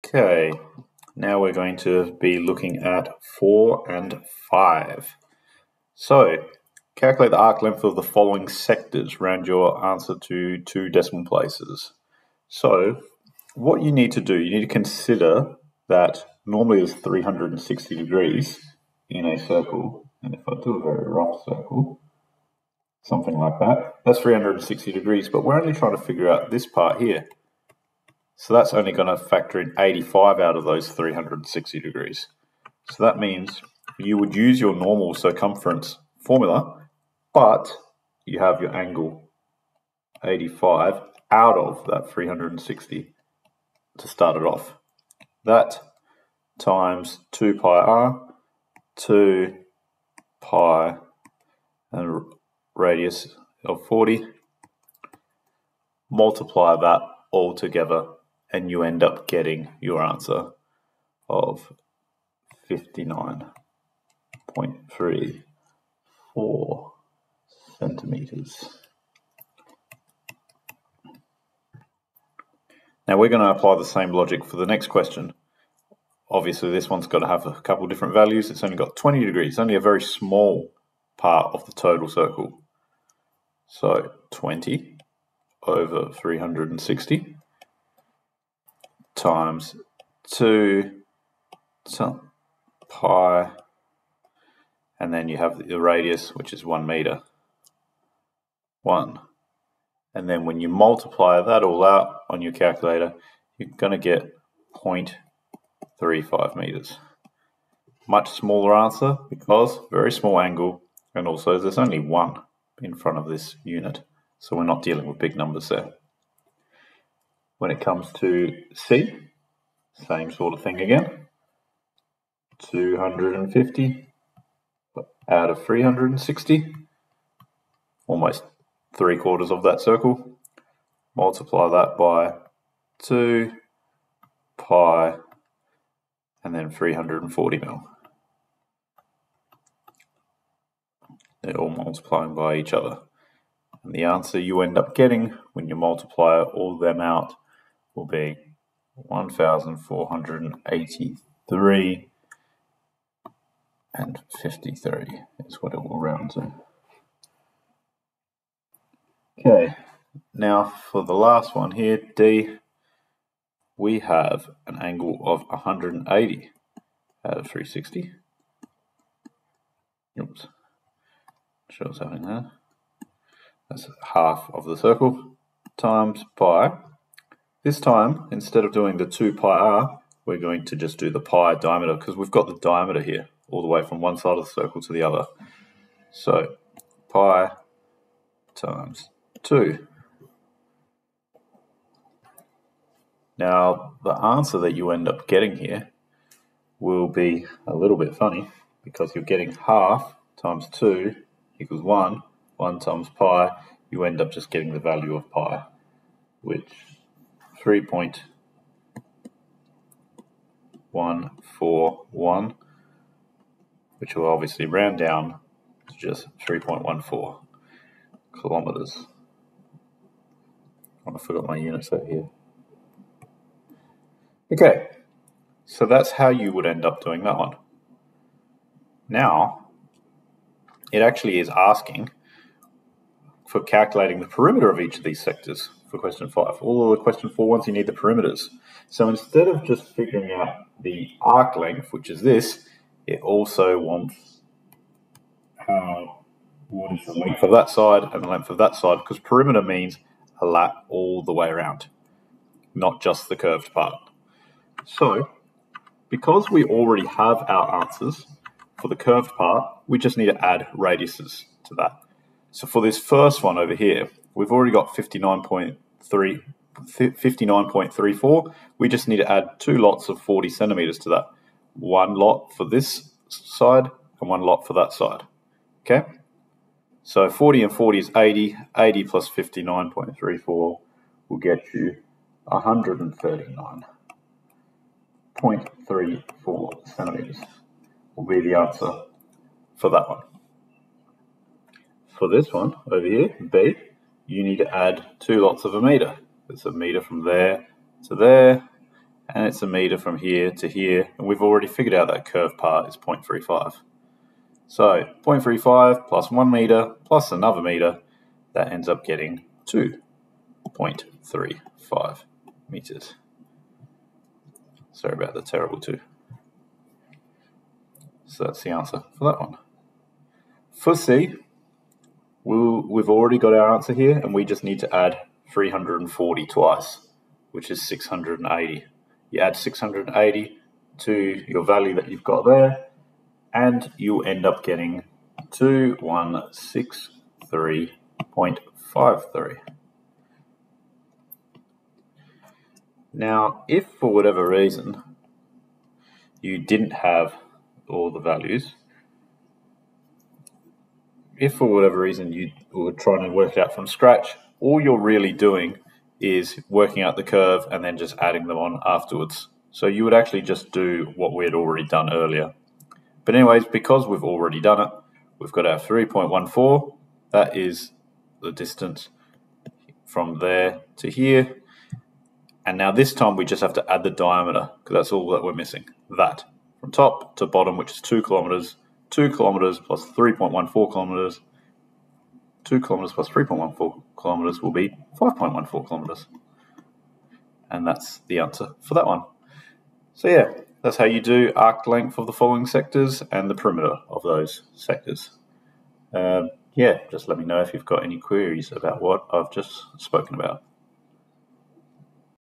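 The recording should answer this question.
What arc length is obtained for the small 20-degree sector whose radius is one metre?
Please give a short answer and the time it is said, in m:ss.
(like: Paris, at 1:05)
0.35 meters, at 1:44.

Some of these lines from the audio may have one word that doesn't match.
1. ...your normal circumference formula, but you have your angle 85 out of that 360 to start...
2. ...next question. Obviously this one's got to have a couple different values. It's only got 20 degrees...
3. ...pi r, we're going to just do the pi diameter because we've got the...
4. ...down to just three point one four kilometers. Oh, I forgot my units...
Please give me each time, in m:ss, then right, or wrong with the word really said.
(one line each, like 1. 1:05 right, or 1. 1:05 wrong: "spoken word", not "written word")
1. 0:34 right
2. 1:14 right
3. 2:59 right
4. 3:34 right.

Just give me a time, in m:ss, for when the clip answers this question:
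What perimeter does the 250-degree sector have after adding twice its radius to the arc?
5:35.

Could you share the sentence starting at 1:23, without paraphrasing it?
So 20 over 360 times 2 so pi, and then you have the radius, which is 1 meter.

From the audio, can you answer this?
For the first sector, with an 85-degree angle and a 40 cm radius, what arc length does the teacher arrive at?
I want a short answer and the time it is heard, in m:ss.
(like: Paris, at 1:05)
59.34 centimeters, at 1:02.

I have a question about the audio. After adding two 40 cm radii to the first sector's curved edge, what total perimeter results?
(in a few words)
139.34 centimeters.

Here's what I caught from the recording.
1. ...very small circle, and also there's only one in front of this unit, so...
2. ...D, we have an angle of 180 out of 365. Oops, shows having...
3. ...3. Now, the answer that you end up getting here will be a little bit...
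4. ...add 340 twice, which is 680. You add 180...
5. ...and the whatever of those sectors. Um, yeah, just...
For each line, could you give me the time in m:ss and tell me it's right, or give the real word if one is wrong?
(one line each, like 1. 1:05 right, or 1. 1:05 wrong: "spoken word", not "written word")
1. 1:49 wrong: "angle", not "circle"
2. 2:42 wrong: "360", not "365"
3. 3:09 wrong: "2", not "3"
4. 5:24 wrong: "680", not "180"
5. 6:33 wrong: "perimeter", not "whatever".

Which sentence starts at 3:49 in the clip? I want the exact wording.
Now, it actually is asking for calculating the perimeter of each of these sectors for question five.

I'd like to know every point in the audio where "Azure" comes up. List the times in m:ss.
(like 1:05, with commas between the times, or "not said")
not said.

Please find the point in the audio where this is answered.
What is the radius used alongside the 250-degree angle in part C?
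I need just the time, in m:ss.
2:16.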